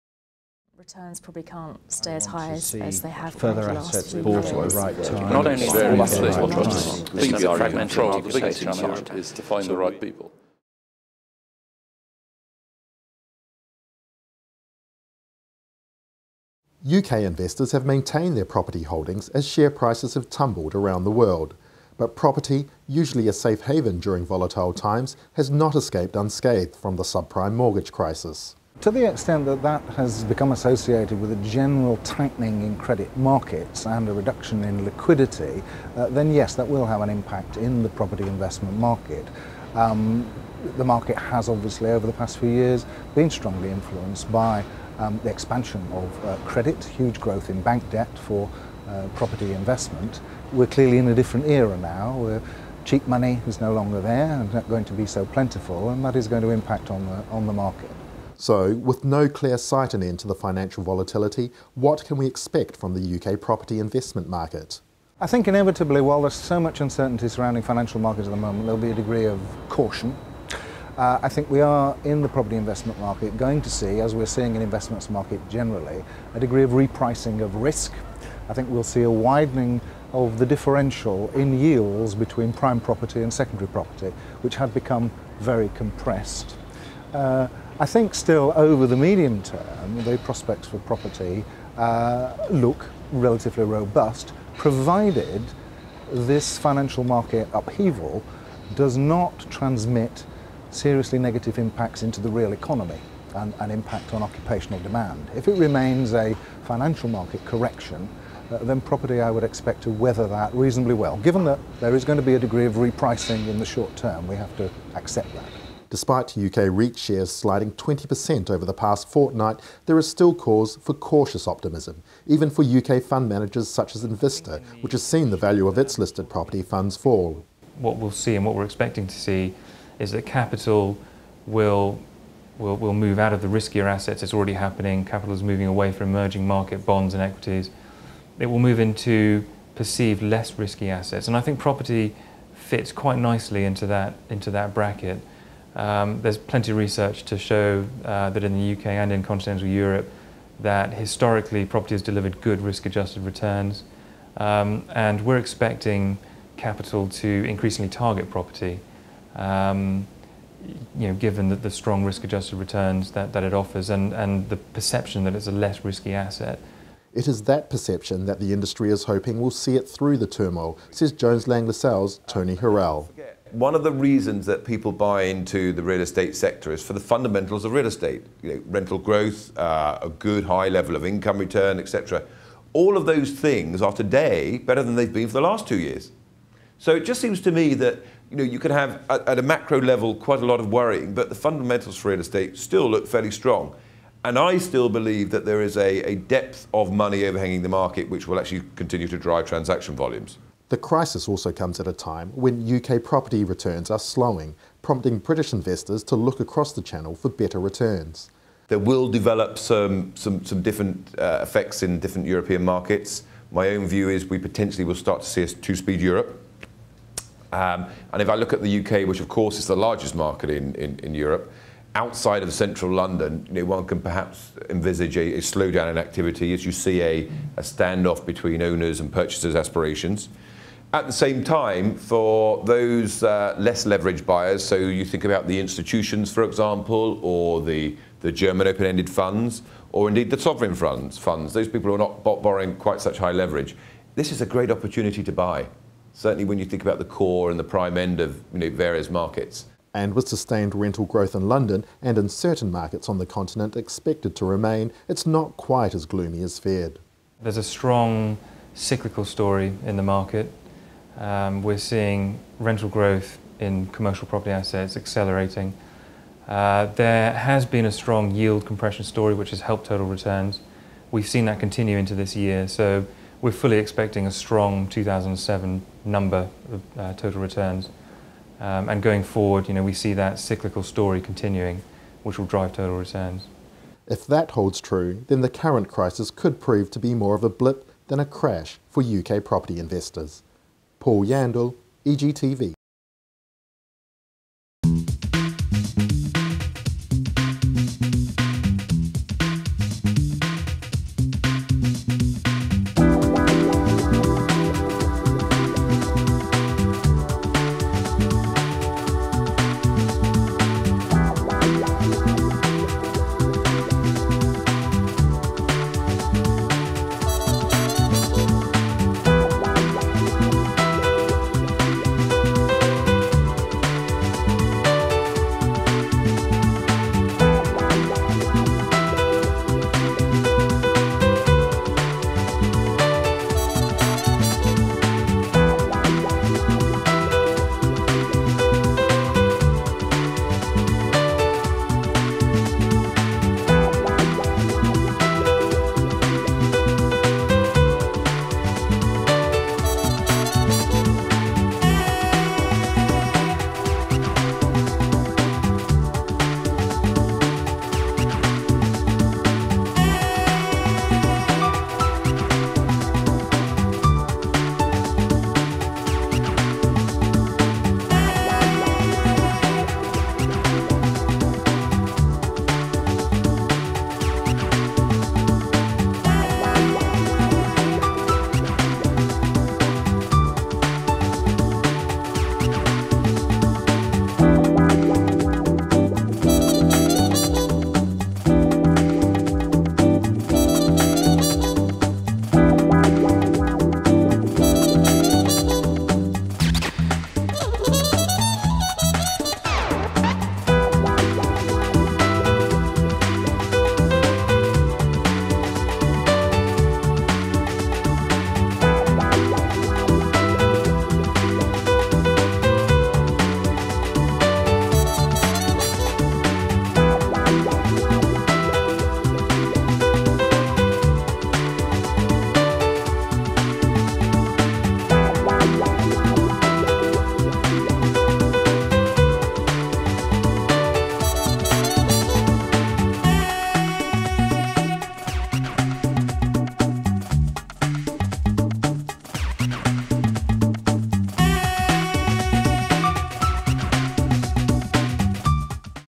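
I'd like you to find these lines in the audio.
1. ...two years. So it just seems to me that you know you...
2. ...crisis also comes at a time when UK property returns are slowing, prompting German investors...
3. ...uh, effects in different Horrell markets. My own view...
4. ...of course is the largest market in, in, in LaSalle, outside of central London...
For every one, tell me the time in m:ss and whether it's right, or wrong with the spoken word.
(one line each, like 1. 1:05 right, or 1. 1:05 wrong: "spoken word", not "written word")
1. 3:05 right
2. 3:20 wrong: "British", not "German"
3. 3:31 wrong: "European", not "Horrell"
4. 3:39 wrong: "Europe", not "LaSalle".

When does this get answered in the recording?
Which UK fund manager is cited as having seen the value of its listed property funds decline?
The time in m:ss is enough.
2:04.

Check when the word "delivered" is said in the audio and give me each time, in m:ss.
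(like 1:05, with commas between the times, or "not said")
2:32.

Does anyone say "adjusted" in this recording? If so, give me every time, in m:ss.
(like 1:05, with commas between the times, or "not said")
2:32, 2:42.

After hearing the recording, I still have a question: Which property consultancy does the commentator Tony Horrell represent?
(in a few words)
Jones Lang LaSalle.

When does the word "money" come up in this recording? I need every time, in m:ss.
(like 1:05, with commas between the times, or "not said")
0:53, 3:16.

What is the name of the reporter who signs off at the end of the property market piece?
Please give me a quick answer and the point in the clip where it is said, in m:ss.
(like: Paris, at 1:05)
Paul Yandall, at 4:51.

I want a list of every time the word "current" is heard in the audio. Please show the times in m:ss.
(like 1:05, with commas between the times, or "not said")
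4:45.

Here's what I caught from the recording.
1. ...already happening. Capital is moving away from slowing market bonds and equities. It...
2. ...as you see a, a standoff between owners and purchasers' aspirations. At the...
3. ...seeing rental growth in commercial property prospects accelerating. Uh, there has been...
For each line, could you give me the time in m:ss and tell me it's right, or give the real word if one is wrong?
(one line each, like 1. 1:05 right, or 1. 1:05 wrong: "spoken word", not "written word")
1. 2:14 wrong: "emerging", not "slowing"
2. 3:46 right
3. 4:21 wrong: "assets", not "prospects".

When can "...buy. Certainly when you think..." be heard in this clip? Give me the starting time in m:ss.
4:05.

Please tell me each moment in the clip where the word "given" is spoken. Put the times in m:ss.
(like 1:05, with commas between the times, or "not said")
1:51, 2:41.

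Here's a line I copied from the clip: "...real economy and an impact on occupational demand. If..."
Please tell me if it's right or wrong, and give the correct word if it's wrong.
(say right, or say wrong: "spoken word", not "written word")
right.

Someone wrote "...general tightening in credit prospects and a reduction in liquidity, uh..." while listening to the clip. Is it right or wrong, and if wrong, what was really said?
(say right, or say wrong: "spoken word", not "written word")
wrong: "markets", not "prospects".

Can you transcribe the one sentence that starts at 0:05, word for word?
Not only very much right right right the is to find the right people.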